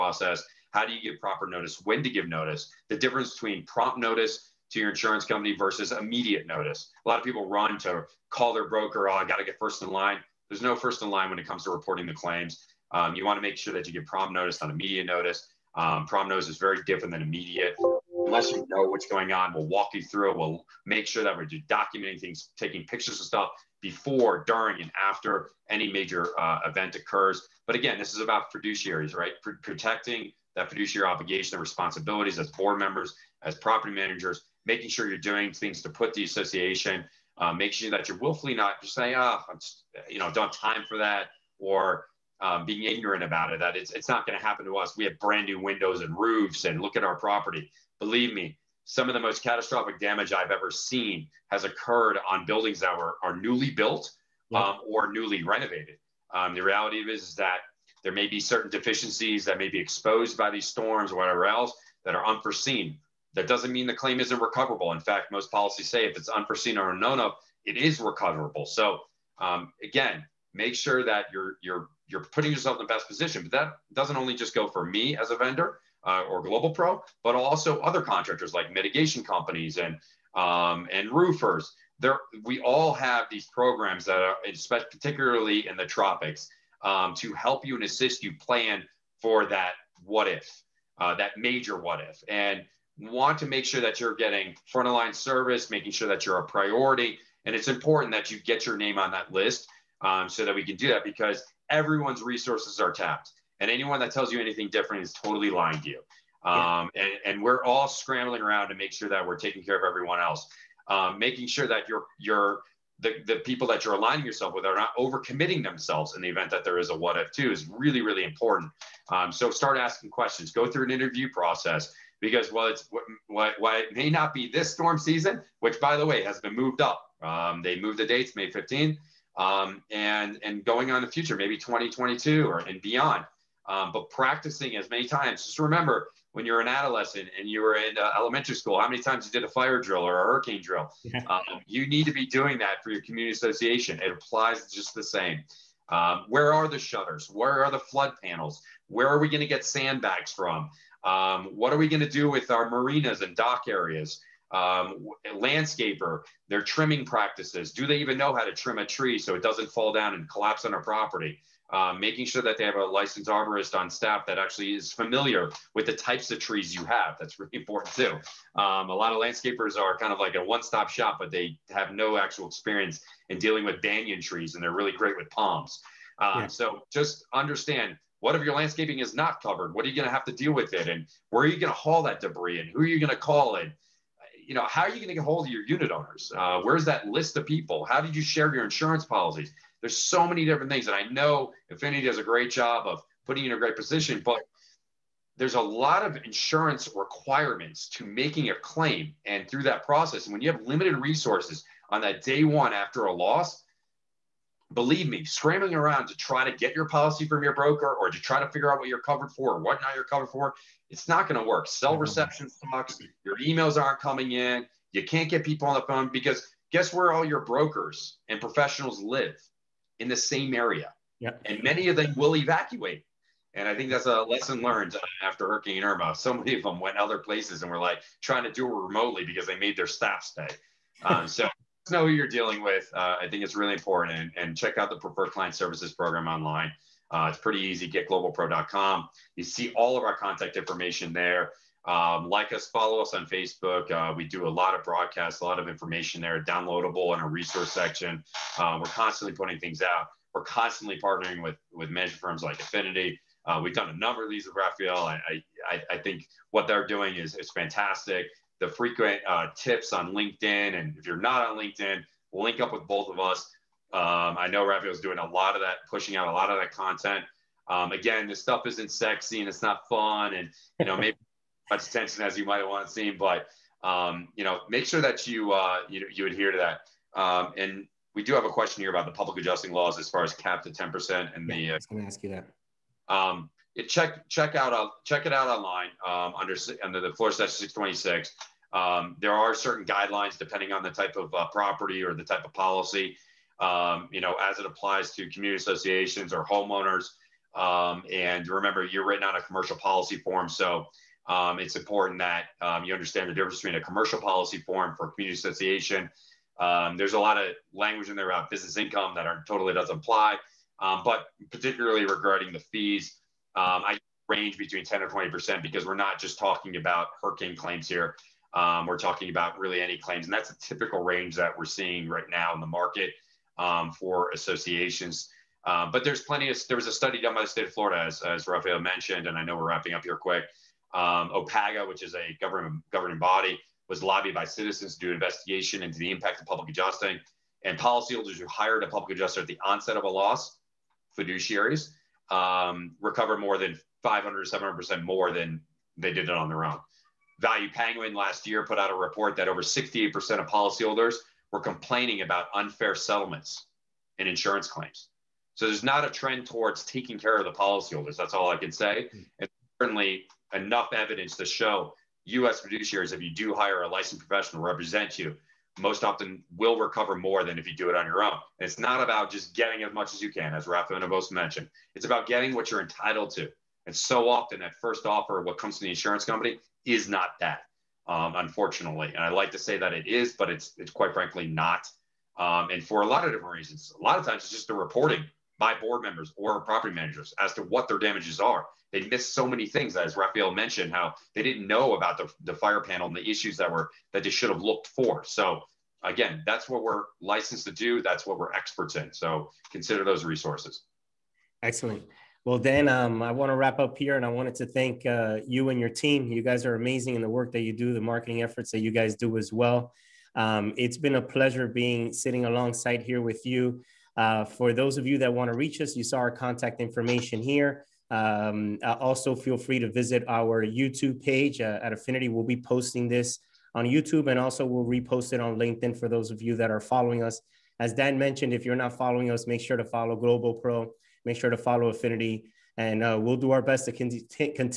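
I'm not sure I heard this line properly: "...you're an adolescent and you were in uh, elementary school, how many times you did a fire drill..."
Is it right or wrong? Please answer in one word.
right.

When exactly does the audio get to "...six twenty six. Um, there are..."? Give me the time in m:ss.
4:47.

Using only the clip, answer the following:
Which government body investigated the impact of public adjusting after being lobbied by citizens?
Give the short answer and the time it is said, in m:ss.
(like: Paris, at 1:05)
OPPAGA, at 5:31.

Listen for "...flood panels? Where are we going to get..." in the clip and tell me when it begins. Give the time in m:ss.
2:27.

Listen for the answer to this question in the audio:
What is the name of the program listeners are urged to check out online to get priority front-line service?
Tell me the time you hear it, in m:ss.
3:54.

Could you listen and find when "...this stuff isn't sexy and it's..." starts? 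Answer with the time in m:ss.
4:28.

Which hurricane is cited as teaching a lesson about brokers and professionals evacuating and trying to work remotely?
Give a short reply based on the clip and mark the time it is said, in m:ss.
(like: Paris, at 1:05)
Hurricane Irma, at 3:45.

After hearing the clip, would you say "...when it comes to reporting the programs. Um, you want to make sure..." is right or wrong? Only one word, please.
wrong.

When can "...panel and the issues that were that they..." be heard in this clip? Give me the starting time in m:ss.
6:32.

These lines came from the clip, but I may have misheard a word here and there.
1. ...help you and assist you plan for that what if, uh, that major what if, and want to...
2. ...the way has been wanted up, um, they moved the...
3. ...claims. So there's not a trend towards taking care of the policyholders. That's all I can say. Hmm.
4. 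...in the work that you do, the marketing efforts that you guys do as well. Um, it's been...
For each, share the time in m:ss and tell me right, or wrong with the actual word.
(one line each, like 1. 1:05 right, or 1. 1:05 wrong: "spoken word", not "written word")
1. 1:27 right
2. 2:05 wrong: "moved", not "wanted"
3. 5:54 right
4. 6:47 right.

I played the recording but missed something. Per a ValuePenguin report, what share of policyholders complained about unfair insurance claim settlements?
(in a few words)
68%.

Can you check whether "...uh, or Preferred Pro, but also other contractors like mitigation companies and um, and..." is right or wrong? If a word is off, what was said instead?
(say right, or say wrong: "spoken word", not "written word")
wrong: "Global", not "Preferred".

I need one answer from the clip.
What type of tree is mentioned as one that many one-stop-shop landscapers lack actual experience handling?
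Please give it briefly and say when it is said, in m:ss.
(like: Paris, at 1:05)
banyan trees, at 2:53.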